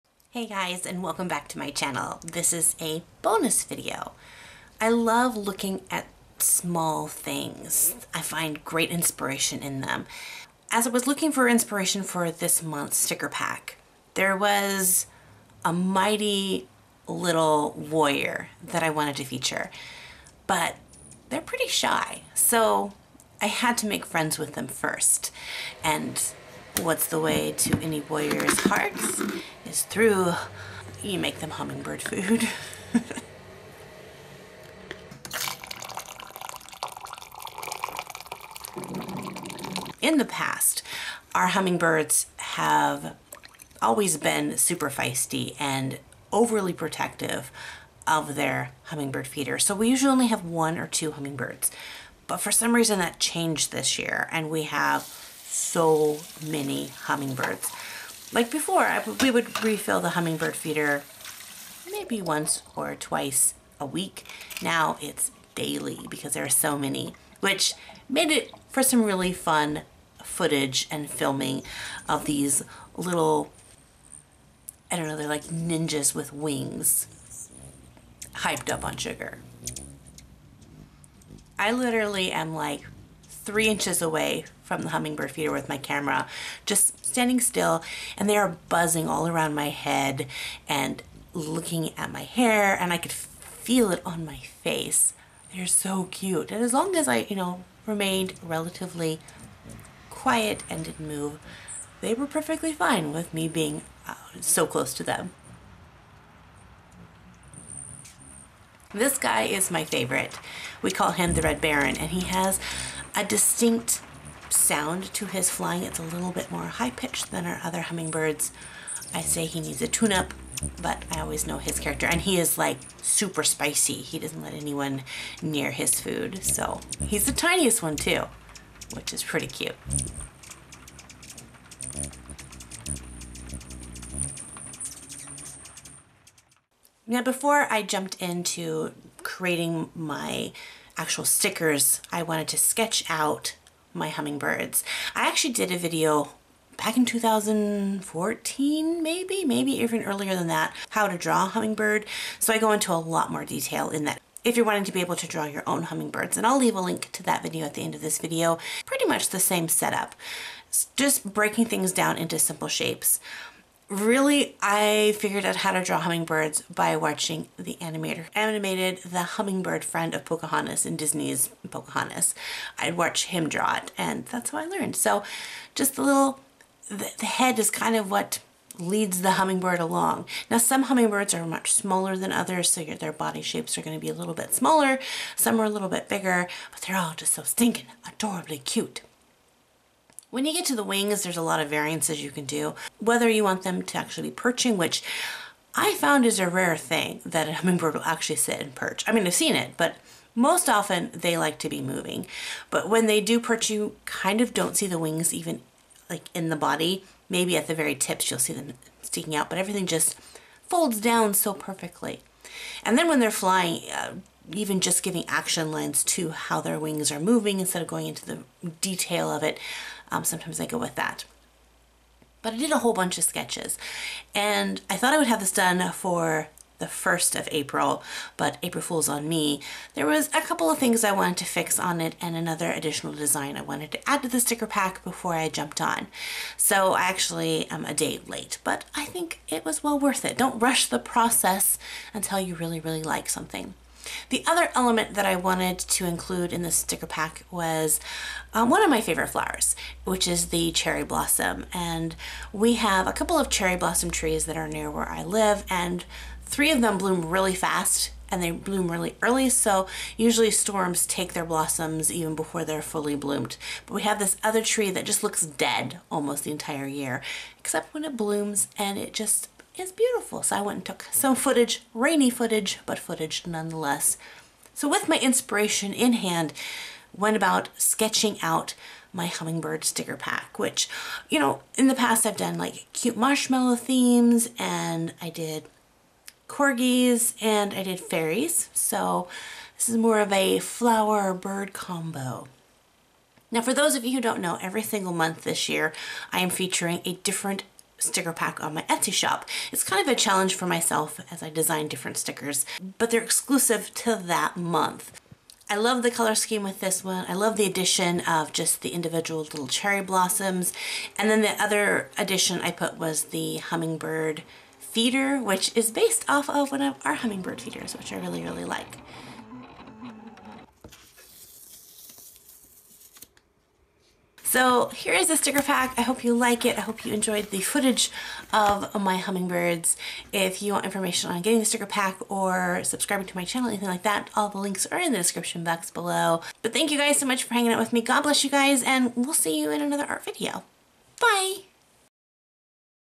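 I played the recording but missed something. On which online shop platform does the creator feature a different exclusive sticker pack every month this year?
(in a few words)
Etsy.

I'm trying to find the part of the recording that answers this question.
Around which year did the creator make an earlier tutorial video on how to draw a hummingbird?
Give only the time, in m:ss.
2:27.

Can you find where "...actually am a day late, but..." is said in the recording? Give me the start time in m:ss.
3:57.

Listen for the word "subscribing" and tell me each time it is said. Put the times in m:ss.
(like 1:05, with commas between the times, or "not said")
5:32.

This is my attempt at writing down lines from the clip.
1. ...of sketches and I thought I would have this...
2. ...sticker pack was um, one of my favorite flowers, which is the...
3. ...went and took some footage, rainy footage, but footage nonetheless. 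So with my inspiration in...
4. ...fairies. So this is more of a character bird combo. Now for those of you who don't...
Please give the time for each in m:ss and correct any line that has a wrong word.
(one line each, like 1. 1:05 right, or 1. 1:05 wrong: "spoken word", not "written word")
1. 3:43 right
2. 4:06 right
3. 4:30 right
4. 4:47 wrong: "flower", not "character".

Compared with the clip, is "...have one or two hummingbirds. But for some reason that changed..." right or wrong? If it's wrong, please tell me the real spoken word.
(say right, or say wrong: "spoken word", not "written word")
right.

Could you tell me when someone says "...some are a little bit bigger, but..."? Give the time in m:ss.
3:05.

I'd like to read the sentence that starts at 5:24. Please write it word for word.
So here is a sticker pack.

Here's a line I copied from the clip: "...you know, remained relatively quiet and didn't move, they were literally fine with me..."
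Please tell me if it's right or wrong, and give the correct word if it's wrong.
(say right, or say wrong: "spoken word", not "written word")
wrong: "perfectly", not "literally".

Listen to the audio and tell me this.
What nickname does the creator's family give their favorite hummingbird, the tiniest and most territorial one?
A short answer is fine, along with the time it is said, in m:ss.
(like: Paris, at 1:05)
Red Baron, at 1:51.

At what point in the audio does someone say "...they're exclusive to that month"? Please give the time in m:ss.
5:03.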